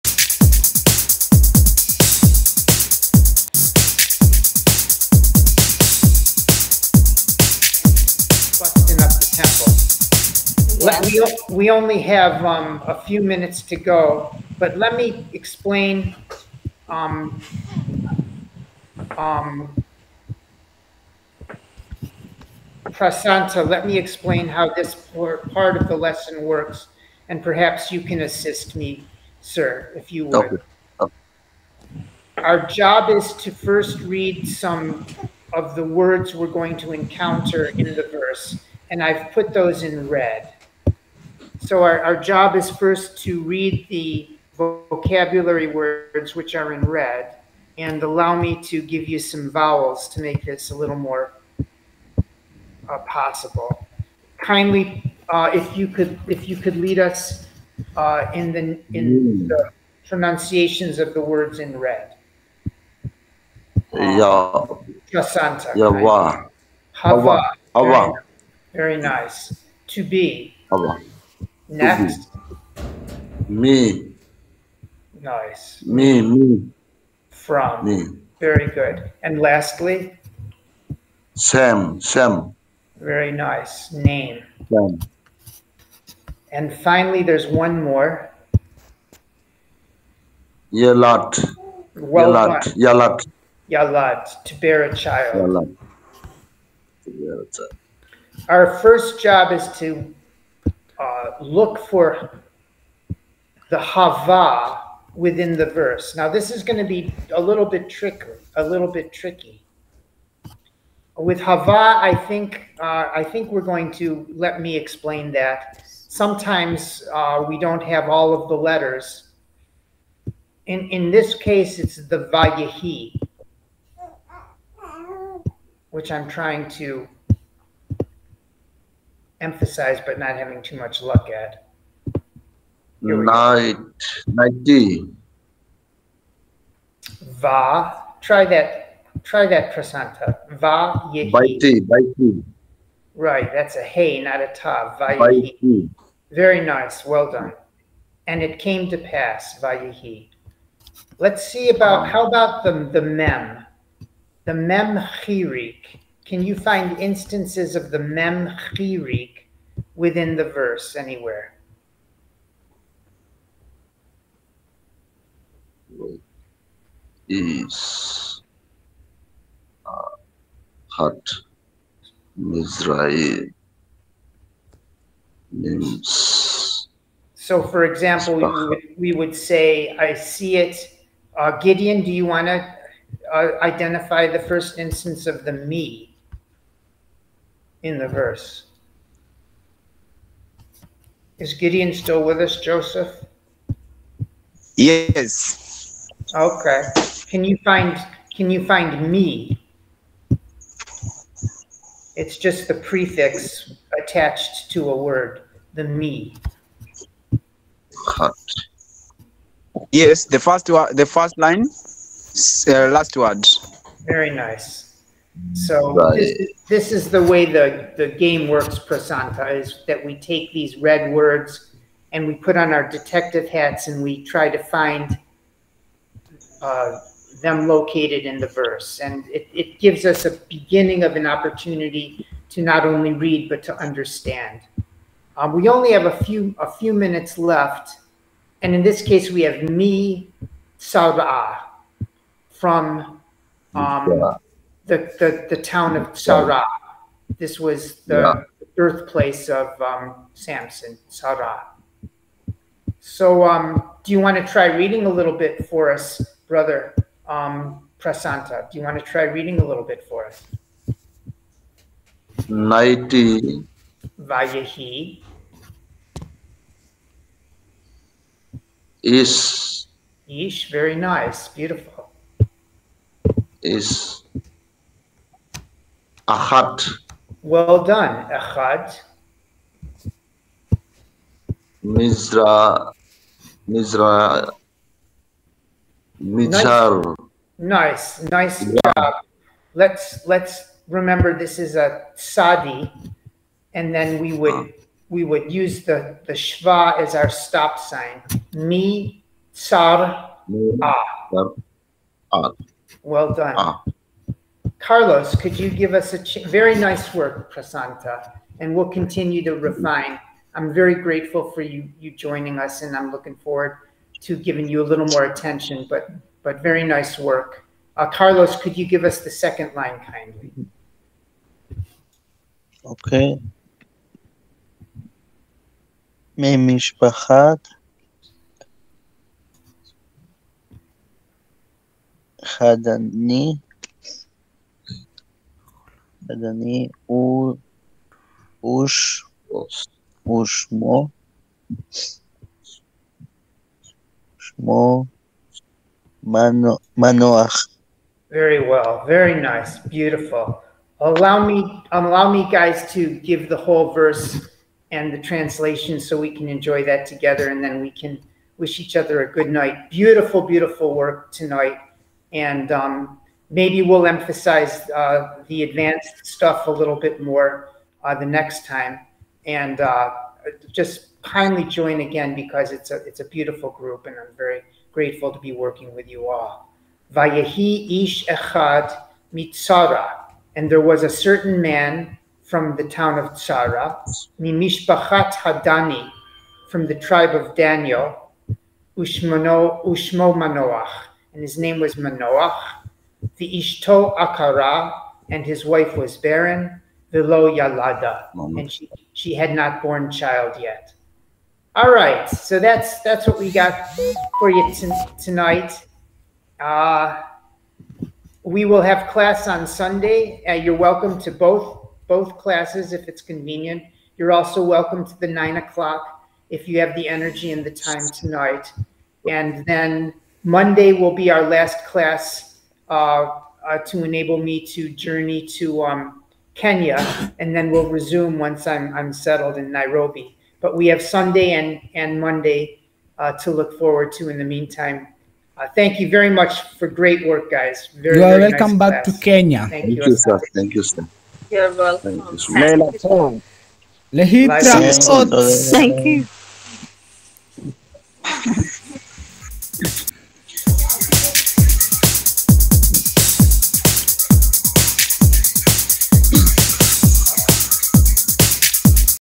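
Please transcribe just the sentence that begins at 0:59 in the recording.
the pronunciations of the words in red.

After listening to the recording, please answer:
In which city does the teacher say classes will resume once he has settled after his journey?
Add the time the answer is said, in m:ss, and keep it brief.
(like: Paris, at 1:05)
Nairobi, at 7:09.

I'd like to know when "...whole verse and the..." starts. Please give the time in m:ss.
5:53.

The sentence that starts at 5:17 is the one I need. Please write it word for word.
Uh, Carlos, could you give us the second line kindly?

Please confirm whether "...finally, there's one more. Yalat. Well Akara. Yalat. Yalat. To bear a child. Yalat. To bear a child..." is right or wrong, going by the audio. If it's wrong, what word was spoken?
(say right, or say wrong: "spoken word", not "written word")
wrong: "Yalat", not "Akara".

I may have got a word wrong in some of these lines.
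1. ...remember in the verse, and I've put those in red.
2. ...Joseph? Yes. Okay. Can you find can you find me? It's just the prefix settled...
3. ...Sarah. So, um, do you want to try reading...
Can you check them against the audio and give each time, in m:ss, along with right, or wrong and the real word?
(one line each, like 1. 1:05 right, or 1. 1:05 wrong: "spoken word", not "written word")
1. 0:36 wrong: "encounter", not "remember"
2. 3:12 wrong: "attached", not "settled"
3. 4:11 right.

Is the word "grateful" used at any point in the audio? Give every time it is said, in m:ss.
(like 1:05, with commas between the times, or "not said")
5:10, 6:14.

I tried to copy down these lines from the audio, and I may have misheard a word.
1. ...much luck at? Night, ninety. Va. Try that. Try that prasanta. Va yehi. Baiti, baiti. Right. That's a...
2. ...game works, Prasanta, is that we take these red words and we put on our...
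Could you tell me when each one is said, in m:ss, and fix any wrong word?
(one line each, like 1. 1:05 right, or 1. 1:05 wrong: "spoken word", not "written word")
1. 2:10 right
2. 3:38 right.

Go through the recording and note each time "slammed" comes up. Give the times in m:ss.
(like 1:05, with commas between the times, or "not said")
not said.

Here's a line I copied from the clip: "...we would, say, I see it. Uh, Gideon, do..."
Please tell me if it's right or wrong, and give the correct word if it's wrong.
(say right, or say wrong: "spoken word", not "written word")
right.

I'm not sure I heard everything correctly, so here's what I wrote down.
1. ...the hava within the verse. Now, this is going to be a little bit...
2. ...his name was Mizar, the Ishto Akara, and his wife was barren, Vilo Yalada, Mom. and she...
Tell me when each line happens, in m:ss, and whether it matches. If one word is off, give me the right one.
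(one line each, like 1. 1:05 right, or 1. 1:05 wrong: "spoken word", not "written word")
1. 1:43 right
2. 6:31 wrong: "Manoach", not "Mizar".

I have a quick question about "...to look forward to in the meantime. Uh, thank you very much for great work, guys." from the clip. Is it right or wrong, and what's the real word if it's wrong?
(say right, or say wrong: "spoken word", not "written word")
right.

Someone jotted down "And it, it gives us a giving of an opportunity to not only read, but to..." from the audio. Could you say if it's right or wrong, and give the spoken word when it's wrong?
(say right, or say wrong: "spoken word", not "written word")
wrong: "beginning", not "giving".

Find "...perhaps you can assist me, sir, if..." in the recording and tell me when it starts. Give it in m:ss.
0:27.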